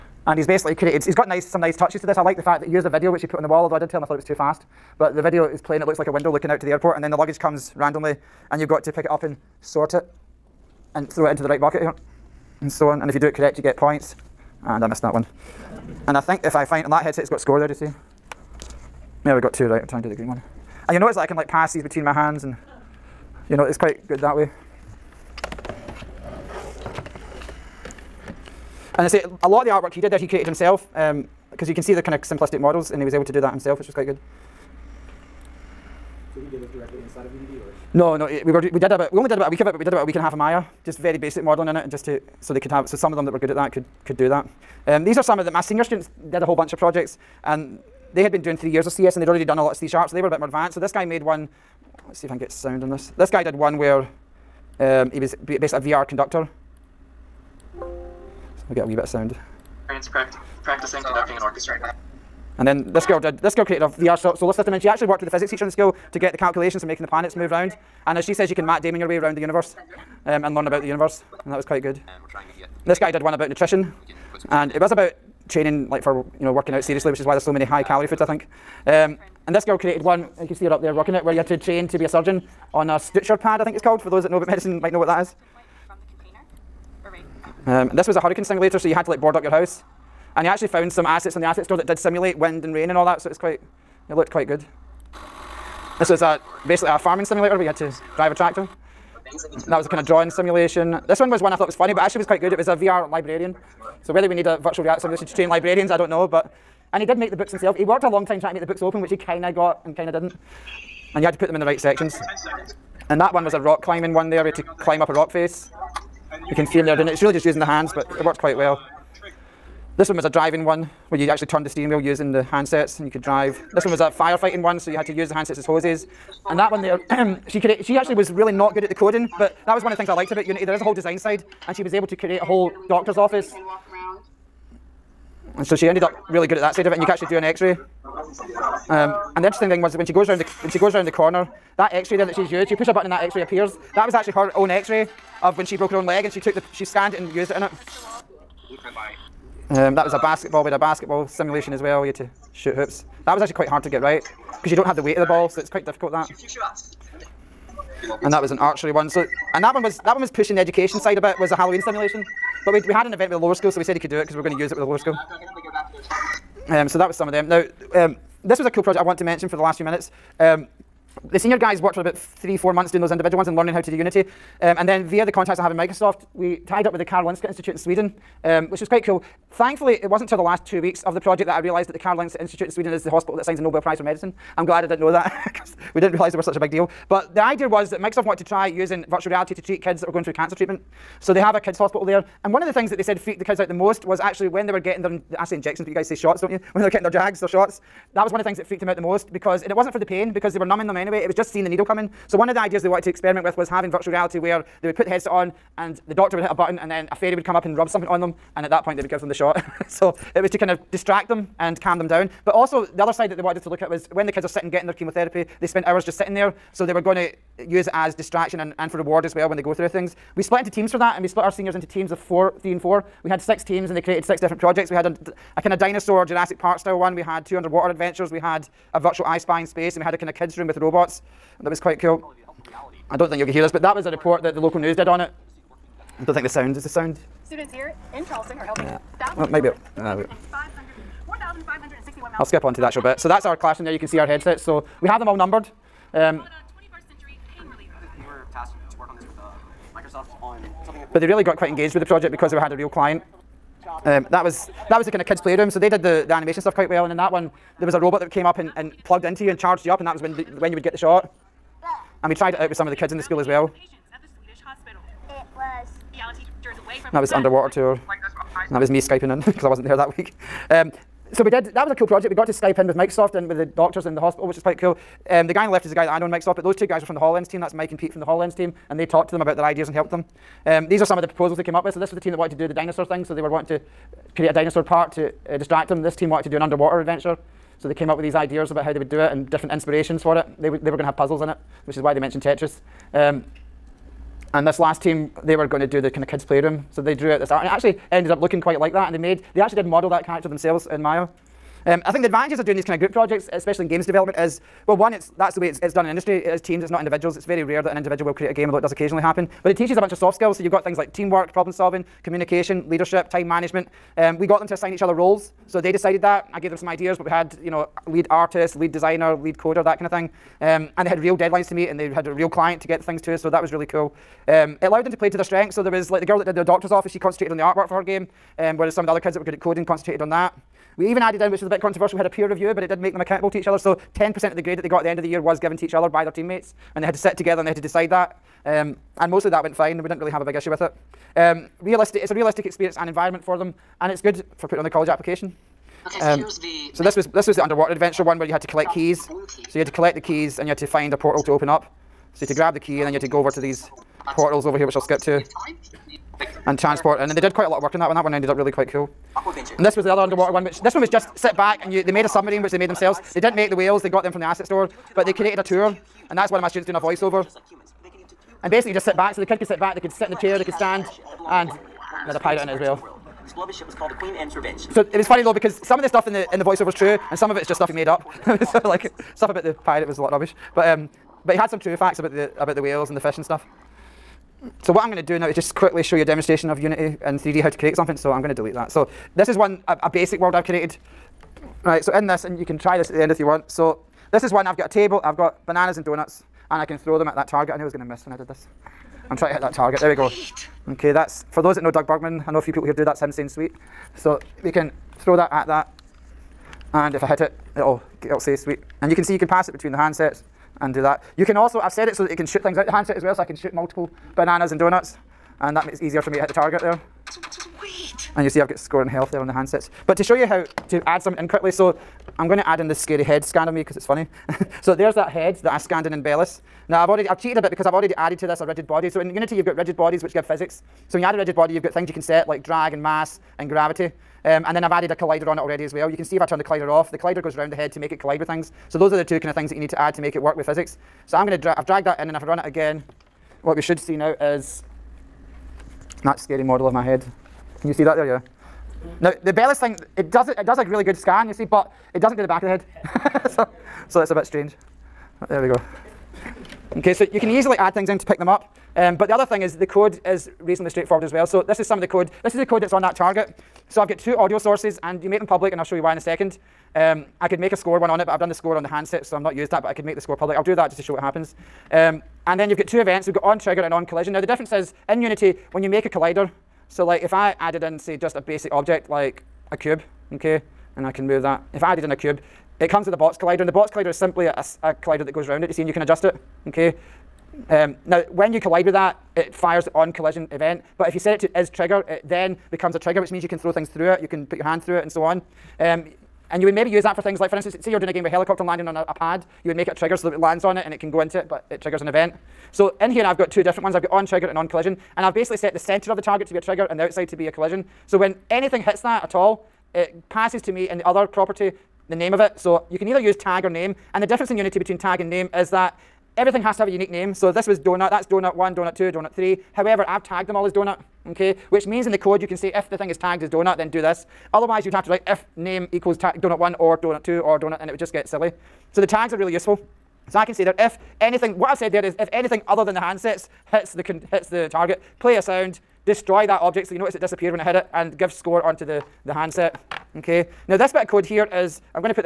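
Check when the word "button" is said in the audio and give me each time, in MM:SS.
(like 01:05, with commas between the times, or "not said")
02:22, 03:26.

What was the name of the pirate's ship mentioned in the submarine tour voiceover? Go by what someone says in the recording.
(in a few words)
Queen Anne's Revenge.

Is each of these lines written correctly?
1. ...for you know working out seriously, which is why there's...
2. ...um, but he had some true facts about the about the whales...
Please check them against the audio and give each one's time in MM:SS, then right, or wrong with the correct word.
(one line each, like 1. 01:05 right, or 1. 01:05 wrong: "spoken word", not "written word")
1. 01:16 right
2. 06:20 right.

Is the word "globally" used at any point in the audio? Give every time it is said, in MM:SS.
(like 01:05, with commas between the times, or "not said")
not said.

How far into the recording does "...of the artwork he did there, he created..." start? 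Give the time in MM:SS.
00:29.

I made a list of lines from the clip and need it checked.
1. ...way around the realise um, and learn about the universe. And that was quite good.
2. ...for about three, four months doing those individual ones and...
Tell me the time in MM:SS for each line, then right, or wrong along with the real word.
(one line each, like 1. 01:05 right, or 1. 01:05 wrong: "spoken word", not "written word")
1. 01:09 wrong: "universe", not "realise"
2. 02:51 right.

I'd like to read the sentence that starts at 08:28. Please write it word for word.
So when anything hits that at all, it passes to me in the other property the name of it.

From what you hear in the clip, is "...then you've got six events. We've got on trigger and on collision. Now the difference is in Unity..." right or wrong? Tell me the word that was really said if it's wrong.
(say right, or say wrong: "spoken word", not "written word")
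wrong: "two", not "six".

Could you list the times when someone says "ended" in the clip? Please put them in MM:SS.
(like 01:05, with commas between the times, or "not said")
02:15, 04:58, 05:58.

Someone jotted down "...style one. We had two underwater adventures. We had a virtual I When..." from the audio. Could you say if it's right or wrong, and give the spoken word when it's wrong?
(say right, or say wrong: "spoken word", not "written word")
wrong: "Spy", not "When".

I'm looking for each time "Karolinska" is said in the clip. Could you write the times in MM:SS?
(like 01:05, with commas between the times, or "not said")
02:57, 03:01.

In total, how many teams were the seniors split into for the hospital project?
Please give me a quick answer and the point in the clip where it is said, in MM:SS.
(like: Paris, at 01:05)
6, at 03:43.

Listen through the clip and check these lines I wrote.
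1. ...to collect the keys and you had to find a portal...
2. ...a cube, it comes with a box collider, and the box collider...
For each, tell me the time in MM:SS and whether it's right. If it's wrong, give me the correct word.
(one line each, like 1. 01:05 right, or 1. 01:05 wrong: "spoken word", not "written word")
1. 05:49 right
2. 08:02 right.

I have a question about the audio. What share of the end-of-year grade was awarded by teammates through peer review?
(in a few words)
10%.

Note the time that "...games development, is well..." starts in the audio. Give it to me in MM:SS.
05:03.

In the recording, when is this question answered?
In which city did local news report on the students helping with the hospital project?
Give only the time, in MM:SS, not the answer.
03:58.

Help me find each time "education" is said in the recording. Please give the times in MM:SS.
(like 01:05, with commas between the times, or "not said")
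02:40.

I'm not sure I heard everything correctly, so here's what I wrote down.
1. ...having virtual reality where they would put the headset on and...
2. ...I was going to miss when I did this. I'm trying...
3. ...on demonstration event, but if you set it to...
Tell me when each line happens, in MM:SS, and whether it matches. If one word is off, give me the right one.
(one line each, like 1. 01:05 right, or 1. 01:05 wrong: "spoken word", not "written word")
1. 03:23 right
2. 06:37 right
3. 08:09 wrong: "collision", not "demonstration".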